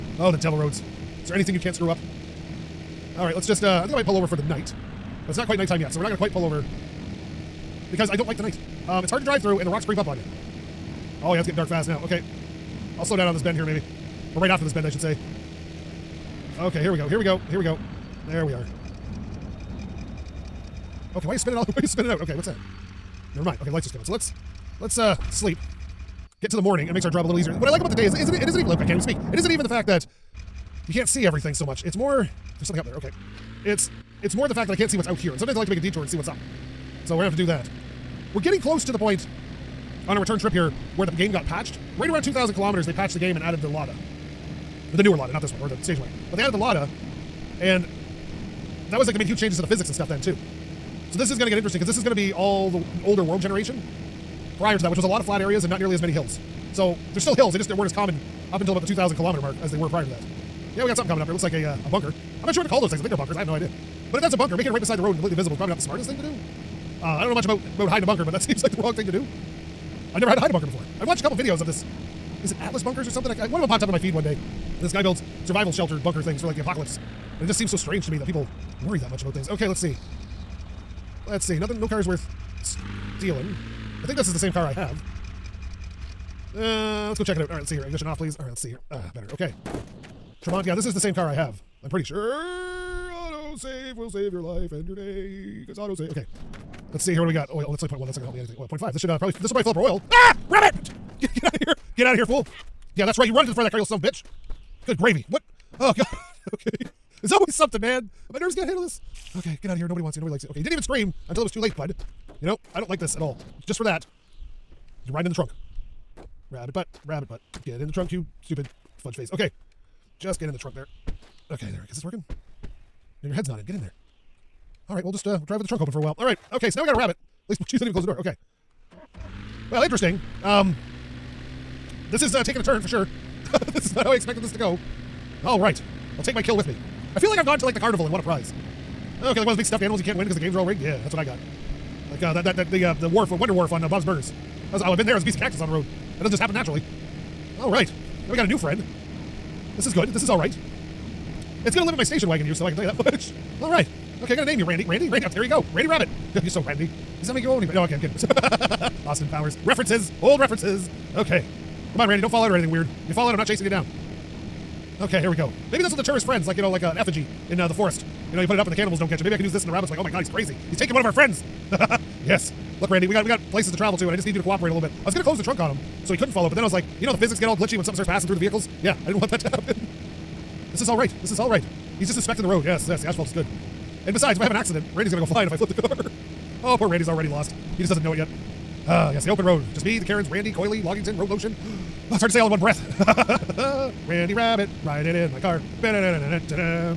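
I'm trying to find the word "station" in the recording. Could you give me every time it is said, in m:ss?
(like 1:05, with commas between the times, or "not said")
0:45, 2:32.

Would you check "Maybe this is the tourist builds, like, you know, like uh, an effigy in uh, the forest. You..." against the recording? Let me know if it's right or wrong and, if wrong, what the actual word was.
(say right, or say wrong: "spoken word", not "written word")
wrong: "friends", not "builds".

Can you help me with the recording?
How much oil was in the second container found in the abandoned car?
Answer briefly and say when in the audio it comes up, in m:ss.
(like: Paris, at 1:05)
0.5, at 1:38.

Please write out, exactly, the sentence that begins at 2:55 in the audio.
I was gonna close the trunk on him, so he couldn't fall out.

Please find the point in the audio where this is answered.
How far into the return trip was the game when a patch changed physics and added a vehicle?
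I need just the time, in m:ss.
0:42.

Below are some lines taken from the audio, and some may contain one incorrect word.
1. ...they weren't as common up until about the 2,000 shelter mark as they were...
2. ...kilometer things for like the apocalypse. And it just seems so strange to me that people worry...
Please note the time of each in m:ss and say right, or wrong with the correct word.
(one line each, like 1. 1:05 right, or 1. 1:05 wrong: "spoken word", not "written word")
1. 0:57 wrong: "kilometer", not "shelter"
2. 1:16 wrong: "bunker", not "kilometer".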